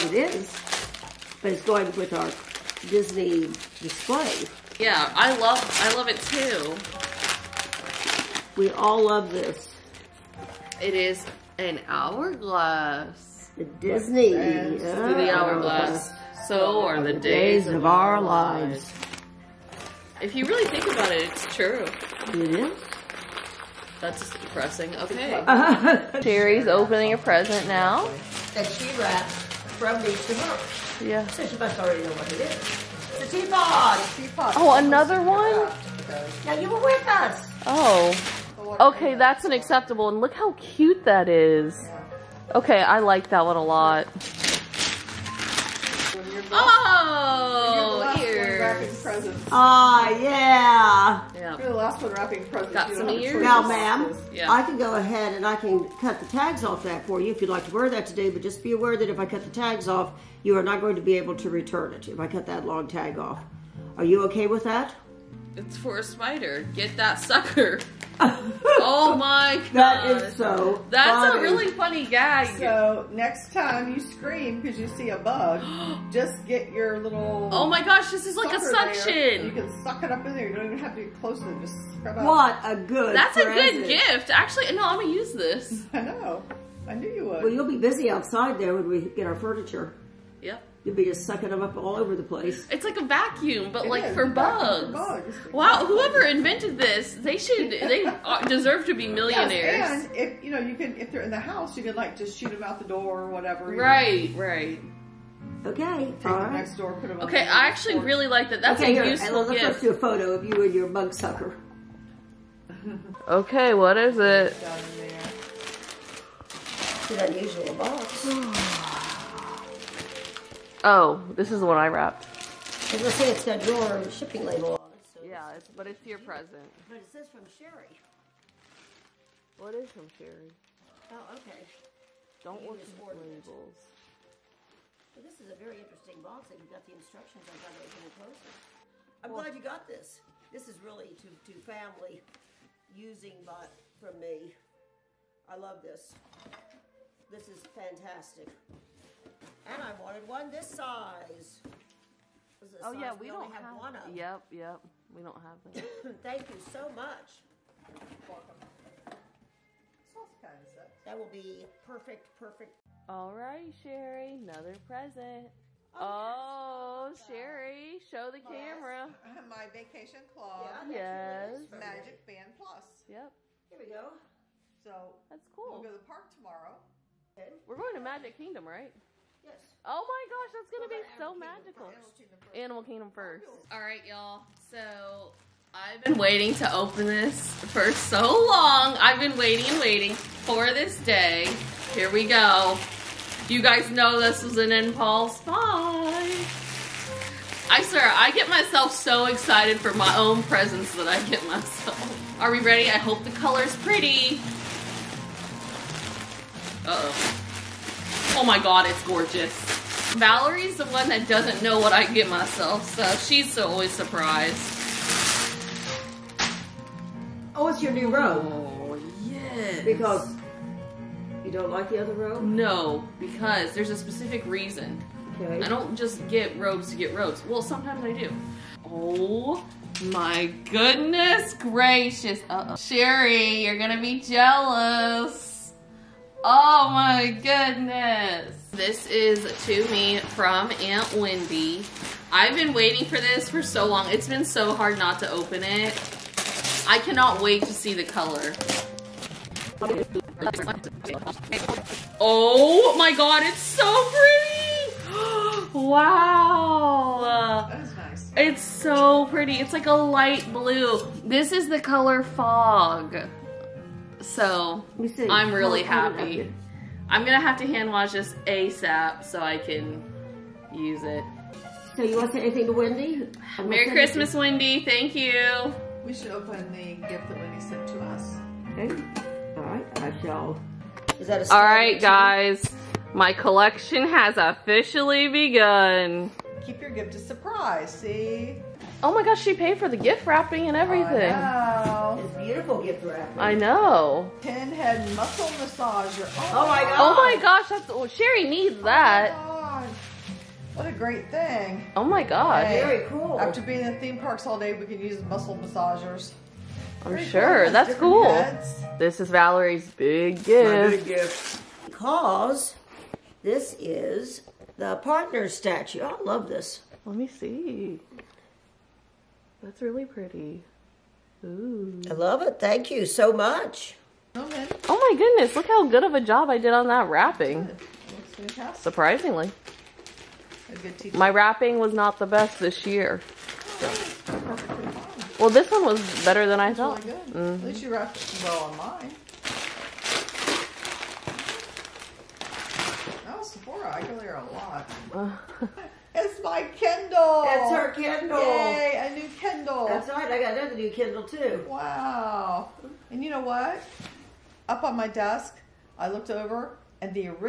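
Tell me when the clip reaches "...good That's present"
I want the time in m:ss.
1:22.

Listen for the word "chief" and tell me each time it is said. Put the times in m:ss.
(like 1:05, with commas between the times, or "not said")
not said.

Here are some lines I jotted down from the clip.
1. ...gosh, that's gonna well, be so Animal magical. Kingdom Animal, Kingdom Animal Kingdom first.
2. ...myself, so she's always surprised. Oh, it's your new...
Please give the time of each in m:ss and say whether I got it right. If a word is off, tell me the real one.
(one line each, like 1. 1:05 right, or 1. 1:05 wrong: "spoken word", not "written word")
1. 3:00 right
2. 3:32 right.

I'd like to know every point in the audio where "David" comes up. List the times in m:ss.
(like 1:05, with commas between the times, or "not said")
not said.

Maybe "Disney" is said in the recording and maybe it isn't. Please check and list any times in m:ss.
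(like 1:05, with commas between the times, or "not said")
0:02, 0:13.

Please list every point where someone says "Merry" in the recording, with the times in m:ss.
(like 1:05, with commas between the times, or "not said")
4:33.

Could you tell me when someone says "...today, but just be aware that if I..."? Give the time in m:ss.
0:58.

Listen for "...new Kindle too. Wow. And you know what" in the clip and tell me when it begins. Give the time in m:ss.
5:50.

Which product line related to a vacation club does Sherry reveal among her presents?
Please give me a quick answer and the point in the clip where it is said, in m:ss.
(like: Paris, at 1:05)
Magic Band Plus, at 2:51.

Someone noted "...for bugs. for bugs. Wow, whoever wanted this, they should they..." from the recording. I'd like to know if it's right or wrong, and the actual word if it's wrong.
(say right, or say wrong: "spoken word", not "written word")
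wrong: "invented", not "wanted".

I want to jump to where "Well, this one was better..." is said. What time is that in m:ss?
5:35.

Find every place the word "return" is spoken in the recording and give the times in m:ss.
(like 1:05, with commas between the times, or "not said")
1:01.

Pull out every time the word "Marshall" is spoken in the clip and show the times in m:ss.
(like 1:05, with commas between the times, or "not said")
not said.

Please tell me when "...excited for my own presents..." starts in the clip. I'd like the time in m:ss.
3:19.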